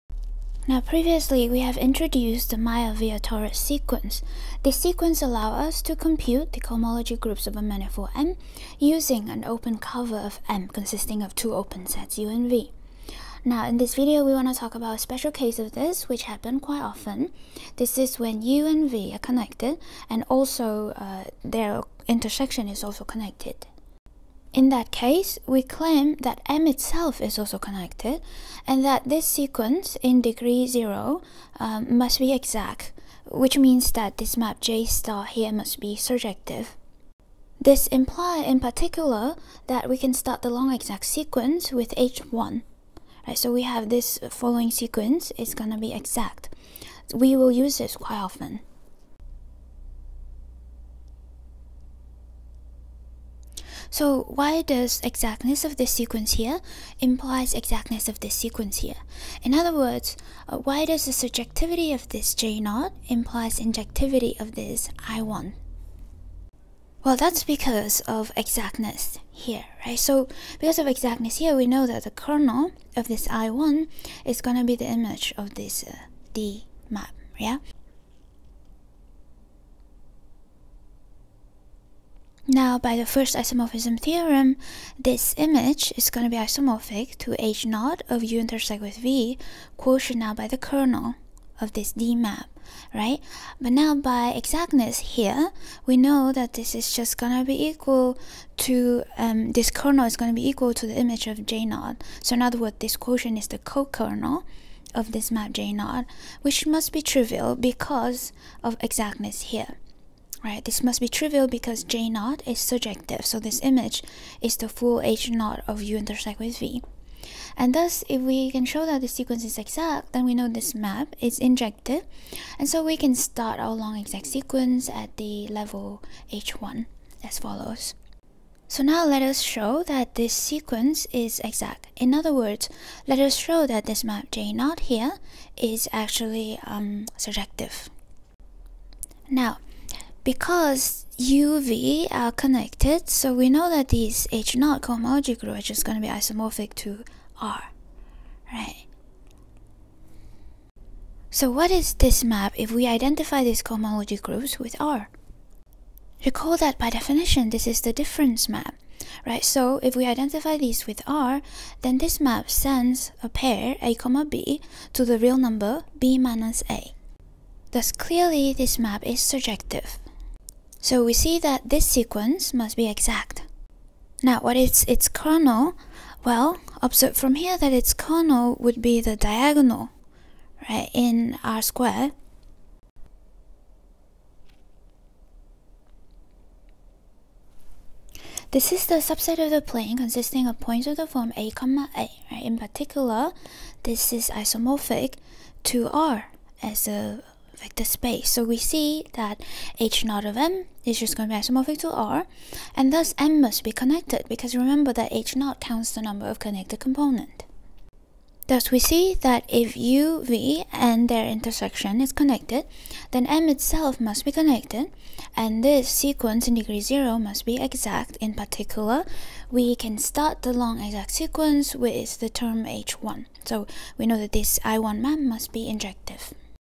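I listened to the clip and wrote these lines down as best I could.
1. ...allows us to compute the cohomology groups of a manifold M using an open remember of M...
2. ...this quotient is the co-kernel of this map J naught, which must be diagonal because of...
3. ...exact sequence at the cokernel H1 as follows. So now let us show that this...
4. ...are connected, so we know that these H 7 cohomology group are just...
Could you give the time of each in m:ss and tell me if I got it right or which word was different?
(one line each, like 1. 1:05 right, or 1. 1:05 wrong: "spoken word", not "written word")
1. 0:05 wrong: "cover", not "remember"
2. 1:42 wrong: "trivial", not "diagonal"
3. 2:03 wrong: "level", not "cokernel"
4. 2:22 wrong: "0", not "7".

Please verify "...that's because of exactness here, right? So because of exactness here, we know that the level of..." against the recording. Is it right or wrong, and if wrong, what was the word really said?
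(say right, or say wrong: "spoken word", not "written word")
wrong: "kernel", not "level".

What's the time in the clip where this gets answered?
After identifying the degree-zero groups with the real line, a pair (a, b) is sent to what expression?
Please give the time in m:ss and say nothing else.
2:45.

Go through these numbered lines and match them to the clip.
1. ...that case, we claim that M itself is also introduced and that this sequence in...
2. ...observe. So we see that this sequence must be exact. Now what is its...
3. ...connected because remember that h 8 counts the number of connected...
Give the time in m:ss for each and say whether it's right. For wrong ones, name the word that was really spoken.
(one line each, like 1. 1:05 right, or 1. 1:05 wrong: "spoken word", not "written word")
1. 0:24 wrong: "connected", not "introduced"
2. 2:49 wrong: "surjective", not "observe"
3. 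3:23 wrong: "0", not "8".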